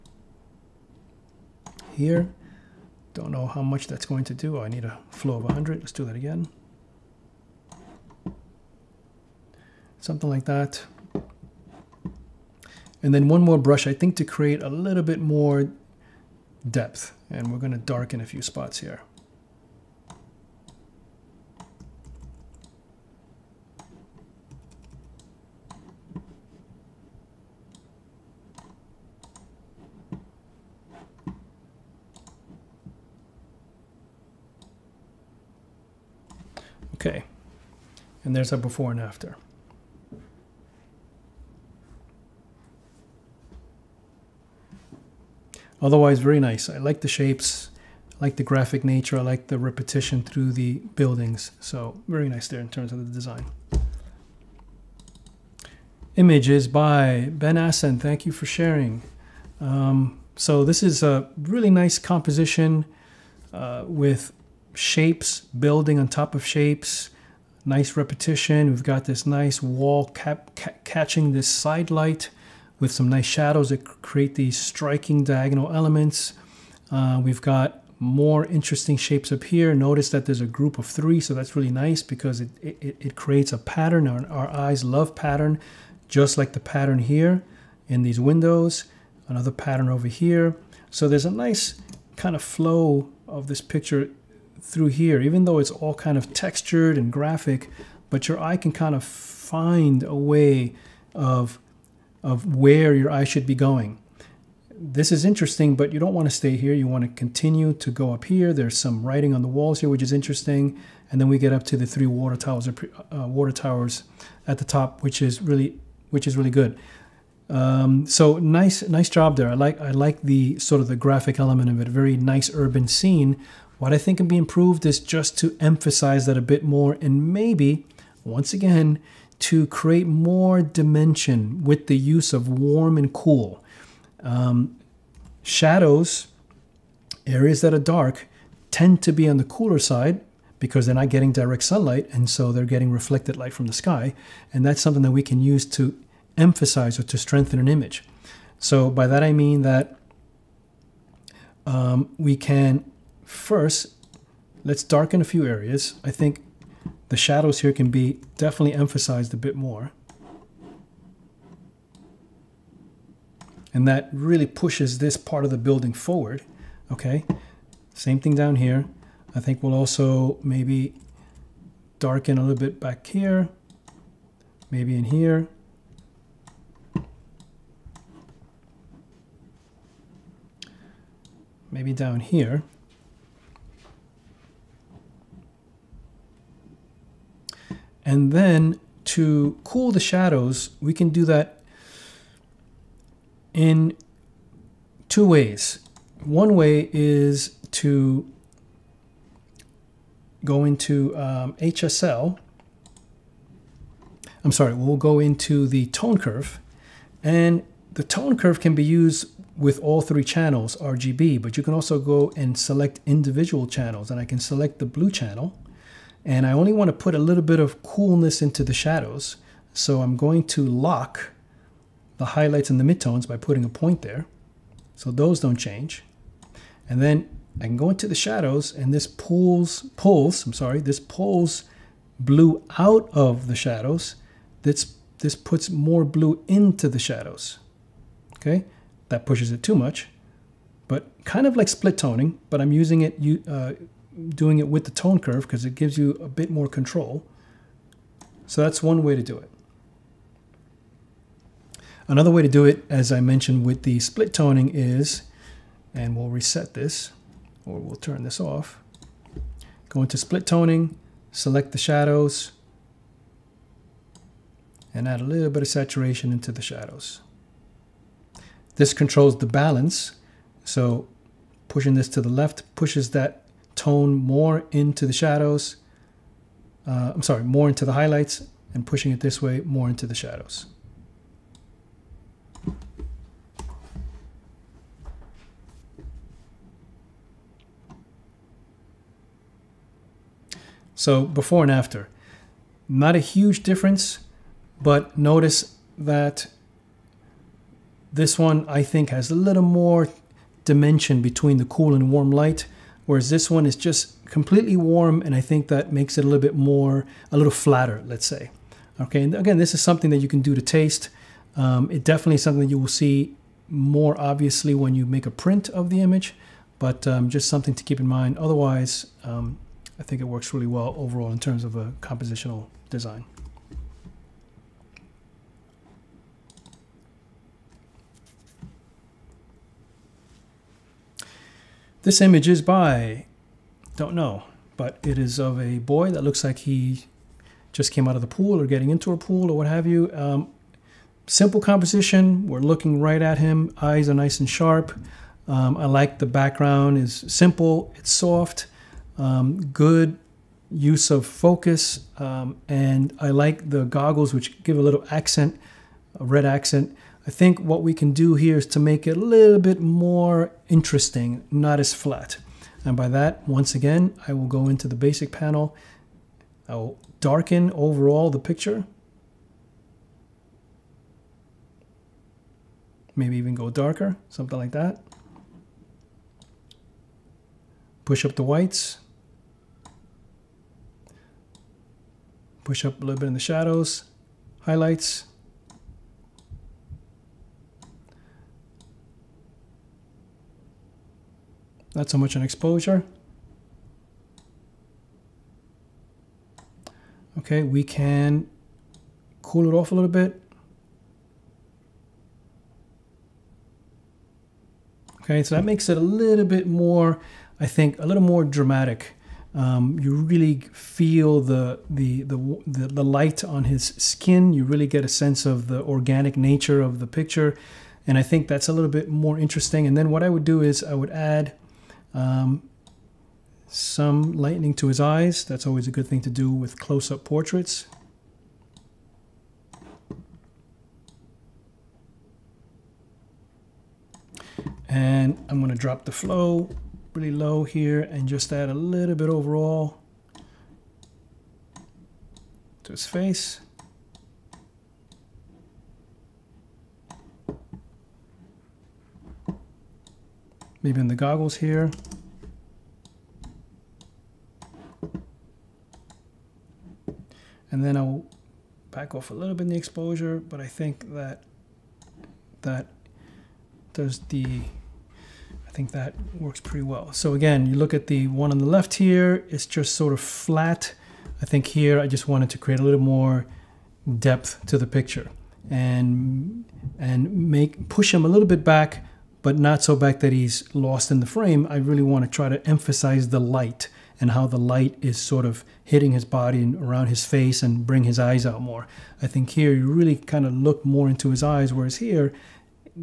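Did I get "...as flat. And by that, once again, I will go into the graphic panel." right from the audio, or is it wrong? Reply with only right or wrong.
wrong.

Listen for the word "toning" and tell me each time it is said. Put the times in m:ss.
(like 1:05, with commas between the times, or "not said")
4:01, 4:14, 4:20.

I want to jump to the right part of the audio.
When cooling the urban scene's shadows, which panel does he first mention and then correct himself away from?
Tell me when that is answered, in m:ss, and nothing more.
3:21.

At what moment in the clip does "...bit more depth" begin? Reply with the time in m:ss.
0:15.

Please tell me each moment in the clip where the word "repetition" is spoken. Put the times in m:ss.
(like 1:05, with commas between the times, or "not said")
0:49, 1:07.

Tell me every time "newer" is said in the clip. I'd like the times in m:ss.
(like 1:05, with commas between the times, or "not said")
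not said.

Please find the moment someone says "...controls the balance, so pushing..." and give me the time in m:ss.
4:28.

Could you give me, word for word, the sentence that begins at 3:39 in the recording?
So I'm going to lock the highlights and the midtones by putting a point there.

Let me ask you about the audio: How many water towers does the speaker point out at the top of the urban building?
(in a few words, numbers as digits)
3.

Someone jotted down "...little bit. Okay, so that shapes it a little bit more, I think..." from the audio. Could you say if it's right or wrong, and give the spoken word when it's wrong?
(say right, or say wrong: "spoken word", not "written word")
wrong: "makes", not "shapes".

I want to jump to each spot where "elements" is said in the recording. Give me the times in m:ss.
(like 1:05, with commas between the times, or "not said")
1:15, 2:01.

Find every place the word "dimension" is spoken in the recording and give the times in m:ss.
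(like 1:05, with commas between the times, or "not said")
2:10, 5:00.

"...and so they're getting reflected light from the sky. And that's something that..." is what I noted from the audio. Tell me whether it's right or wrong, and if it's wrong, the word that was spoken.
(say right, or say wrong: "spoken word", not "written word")
right.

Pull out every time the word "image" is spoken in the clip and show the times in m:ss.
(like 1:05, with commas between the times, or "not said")
0:56, 2:27, 5:16, 5:32.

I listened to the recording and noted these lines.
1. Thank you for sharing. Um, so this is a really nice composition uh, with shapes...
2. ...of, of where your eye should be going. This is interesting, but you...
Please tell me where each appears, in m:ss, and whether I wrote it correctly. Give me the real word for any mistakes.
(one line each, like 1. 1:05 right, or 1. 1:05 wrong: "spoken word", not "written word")
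1. 0:58 right
2. 1:41 right.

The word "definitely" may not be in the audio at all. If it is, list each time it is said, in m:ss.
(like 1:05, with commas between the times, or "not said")
2:38, 5:12.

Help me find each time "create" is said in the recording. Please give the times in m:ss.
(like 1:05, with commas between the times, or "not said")
0:14, 1:14, 1:23, 2:09, 7:52.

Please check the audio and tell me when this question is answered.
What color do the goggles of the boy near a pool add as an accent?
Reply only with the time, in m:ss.
5:56.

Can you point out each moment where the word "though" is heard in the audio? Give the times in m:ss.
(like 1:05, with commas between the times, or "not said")
1:35.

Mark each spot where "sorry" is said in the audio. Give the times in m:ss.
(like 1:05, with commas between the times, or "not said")
3:24, 3:50, 4:37.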